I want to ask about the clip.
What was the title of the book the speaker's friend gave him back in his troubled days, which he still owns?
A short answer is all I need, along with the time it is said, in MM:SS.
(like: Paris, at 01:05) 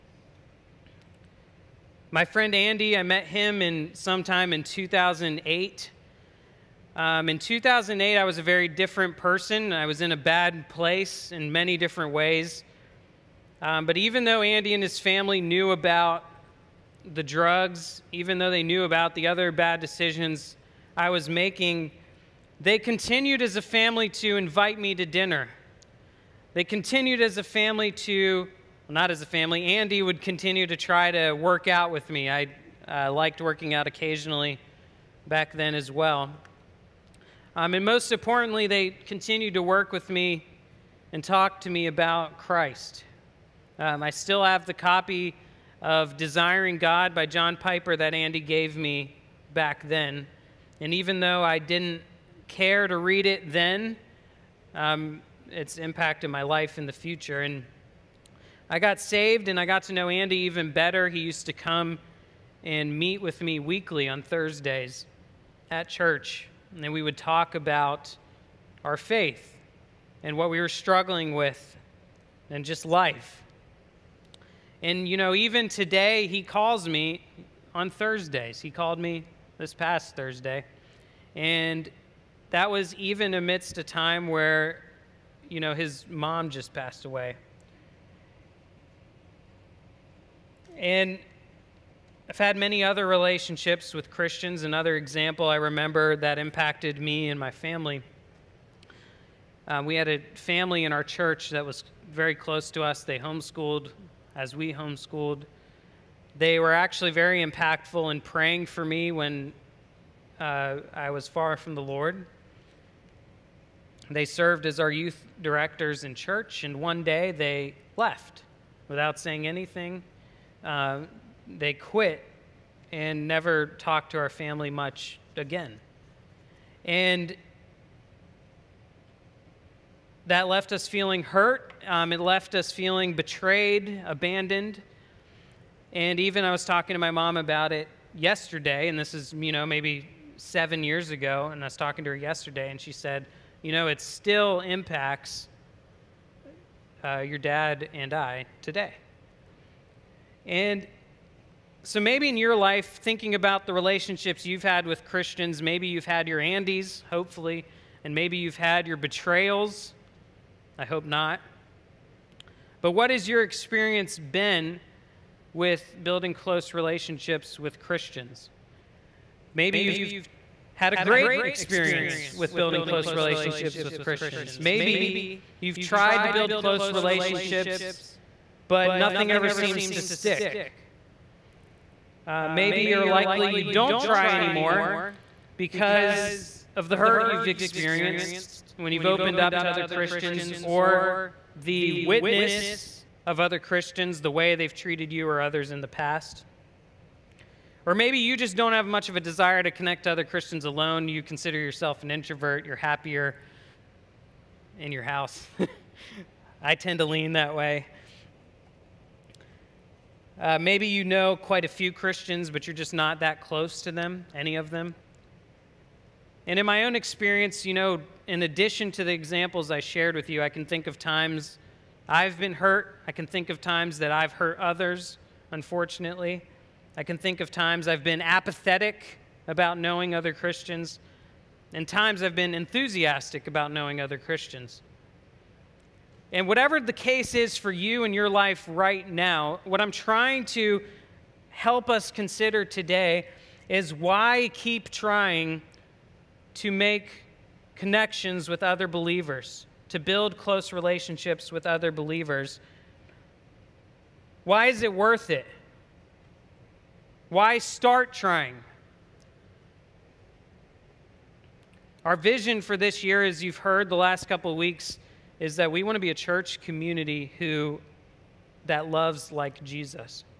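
Desiring God, at 00:46.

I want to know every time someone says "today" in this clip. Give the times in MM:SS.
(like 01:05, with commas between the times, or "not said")
01:15, 02:28, 04:02.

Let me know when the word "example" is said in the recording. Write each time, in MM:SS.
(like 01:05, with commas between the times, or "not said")
01:34, 03:39.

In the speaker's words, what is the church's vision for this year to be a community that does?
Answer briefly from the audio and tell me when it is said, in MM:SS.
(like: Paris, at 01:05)
Loves like Jesus, at 04:28.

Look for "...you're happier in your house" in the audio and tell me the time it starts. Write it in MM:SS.
03:22.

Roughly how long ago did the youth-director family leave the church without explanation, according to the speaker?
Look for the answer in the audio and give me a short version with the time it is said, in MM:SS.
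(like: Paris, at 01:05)
7 years ago, at 02:20.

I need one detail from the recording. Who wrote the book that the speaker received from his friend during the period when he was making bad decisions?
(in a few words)
John Piper.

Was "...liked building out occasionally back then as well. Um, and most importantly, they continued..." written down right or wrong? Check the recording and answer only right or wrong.
wrong.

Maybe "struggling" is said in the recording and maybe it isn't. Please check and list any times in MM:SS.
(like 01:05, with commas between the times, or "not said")
01:10.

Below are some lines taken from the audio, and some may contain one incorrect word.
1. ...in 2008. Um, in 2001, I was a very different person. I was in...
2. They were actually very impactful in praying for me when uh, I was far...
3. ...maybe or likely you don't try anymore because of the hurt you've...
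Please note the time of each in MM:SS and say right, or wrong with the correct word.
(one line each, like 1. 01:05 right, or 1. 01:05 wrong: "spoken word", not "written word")
1. 00:04 wrong: "2008", not "2001"
2. 01:46 right
3. 03:02 right.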